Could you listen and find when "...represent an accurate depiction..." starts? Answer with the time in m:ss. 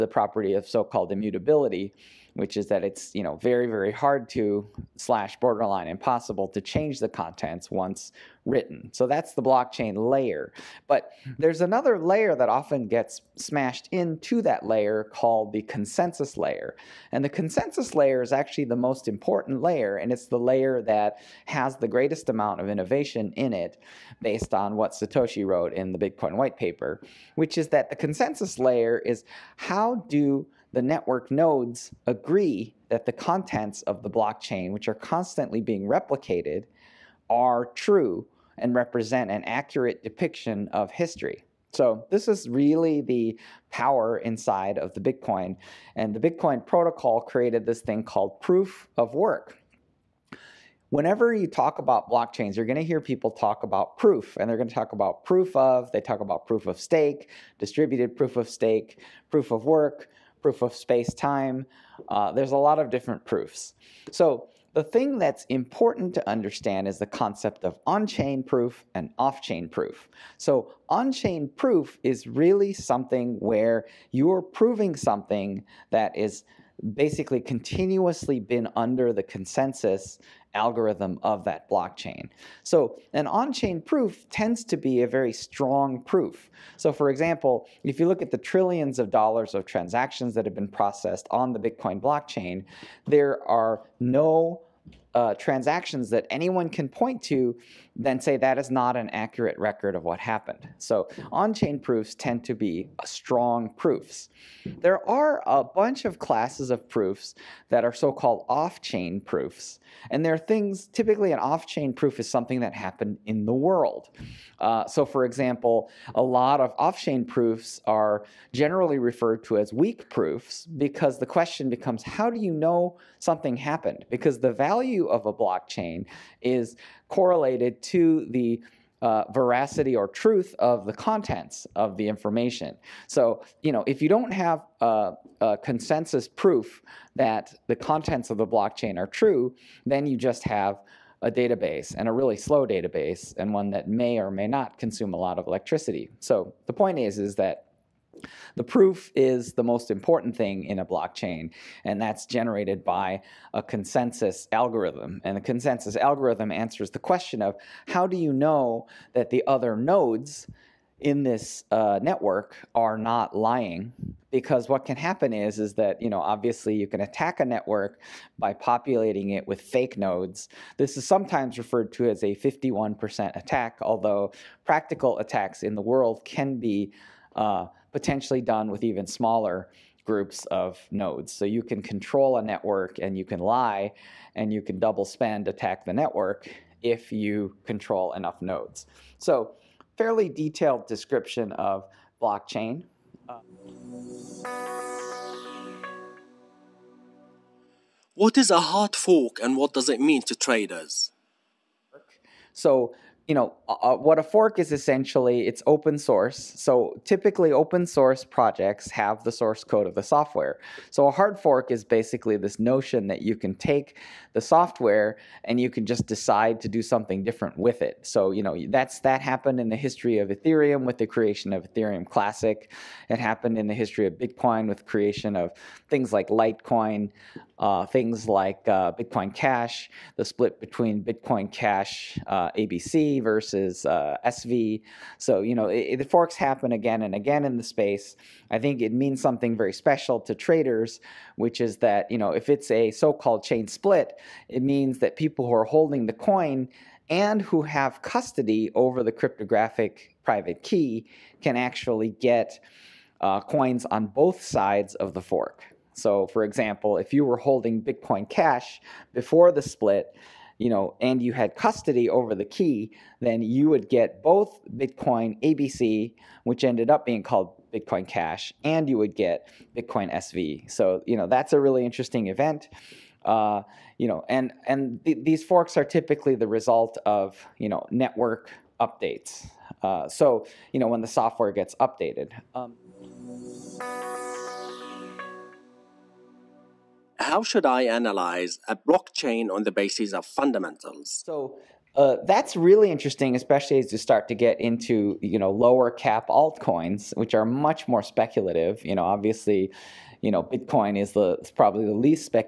0:38.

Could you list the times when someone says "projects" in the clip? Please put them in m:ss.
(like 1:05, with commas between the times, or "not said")
3:28.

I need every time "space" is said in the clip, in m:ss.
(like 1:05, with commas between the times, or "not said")
1:00, 3:57.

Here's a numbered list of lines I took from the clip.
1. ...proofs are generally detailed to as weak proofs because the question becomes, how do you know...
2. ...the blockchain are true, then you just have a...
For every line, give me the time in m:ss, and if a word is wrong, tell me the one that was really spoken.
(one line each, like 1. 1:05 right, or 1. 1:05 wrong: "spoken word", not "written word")
1. 1:57 wrong: "referred", not "detailed"
2. 2:18 right.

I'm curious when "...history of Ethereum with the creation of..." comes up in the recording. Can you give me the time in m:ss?
3:39.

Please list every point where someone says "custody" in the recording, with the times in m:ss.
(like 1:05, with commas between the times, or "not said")
4:08, 4:21.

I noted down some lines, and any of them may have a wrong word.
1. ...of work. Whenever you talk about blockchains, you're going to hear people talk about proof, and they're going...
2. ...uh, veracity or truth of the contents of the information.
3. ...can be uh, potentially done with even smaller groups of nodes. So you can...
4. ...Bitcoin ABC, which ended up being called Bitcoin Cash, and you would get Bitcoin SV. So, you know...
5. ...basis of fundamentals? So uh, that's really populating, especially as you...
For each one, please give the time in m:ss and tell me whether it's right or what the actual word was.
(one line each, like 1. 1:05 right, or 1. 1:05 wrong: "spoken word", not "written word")
1. 0:48 right
2. 2:08 right
3. 2:56 right
4. 4:24 right
5. 4:49 wrong: "interesting", not "populating".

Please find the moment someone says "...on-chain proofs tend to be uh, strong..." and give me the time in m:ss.
1:41.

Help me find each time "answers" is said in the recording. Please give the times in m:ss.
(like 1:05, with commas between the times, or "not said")
2:36.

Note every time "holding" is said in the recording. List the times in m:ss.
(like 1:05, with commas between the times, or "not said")
4:05, 4:17.